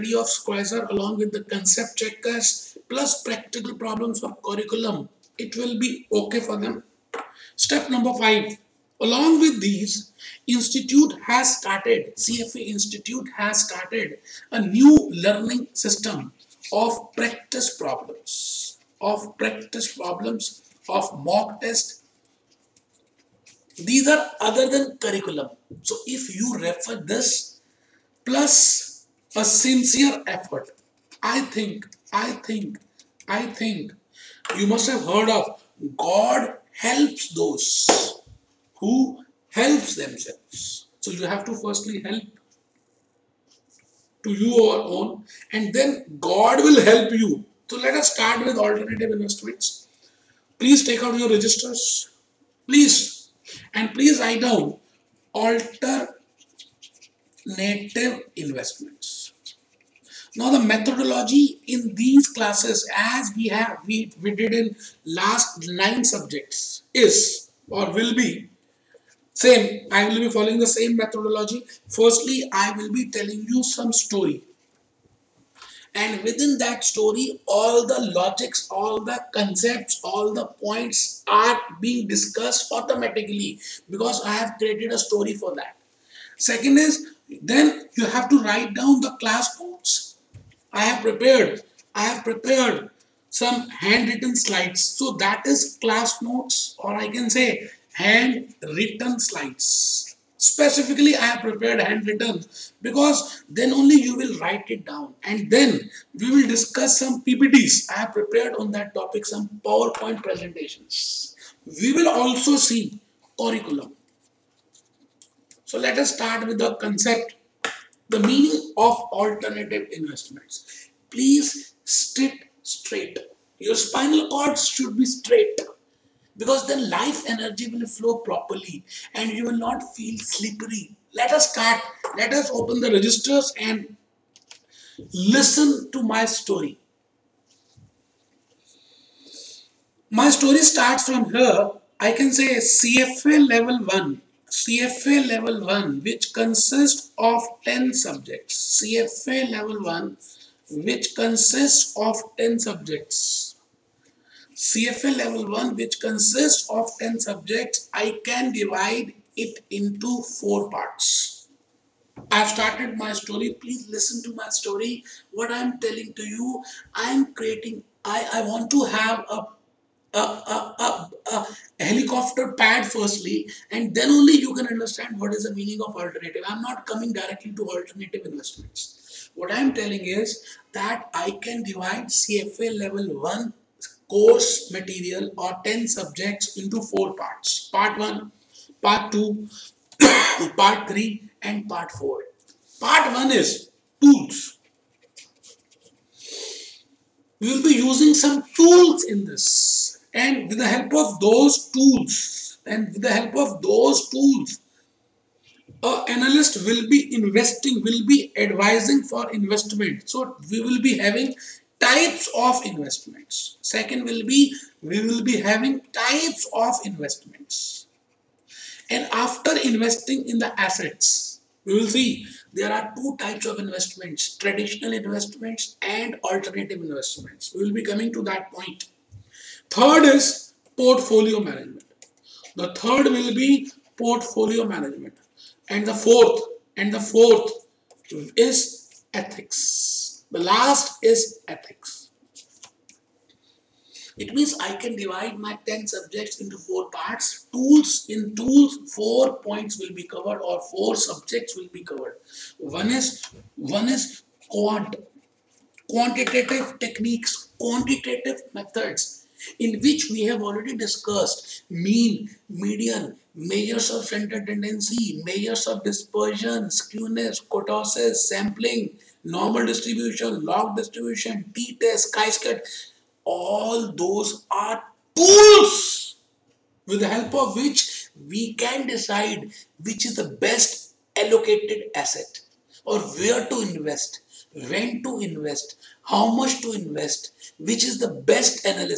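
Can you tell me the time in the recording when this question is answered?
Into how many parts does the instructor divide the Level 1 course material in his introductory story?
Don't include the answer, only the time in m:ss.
2:40.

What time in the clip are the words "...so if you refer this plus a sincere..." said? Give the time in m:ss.
0:25.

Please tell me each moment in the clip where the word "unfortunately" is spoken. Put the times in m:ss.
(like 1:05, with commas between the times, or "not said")
not said.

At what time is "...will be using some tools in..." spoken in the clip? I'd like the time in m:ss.
3:17.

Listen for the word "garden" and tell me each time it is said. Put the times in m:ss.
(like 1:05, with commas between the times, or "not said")
not said.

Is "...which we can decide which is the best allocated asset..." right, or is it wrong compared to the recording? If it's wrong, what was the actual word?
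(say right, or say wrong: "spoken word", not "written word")
right.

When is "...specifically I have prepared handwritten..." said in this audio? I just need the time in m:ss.
1:40.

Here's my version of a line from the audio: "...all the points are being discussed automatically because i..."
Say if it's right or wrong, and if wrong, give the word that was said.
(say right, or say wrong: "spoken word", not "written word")
right.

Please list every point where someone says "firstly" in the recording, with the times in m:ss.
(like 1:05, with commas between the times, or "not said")
0:41, 1:11, 2:52.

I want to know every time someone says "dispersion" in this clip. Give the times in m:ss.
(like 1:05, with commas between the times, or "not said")
4:25.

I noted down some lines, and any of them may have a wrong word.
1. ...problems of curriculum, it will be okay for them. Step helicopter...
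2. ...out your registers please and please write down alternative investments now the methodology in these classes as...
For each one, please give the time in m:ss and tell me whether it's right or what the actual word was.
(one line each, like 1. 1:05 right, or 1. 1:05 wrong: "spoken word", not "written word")
1. 0:03 wrong: "number", not "helicopter"
2. 0:51 right.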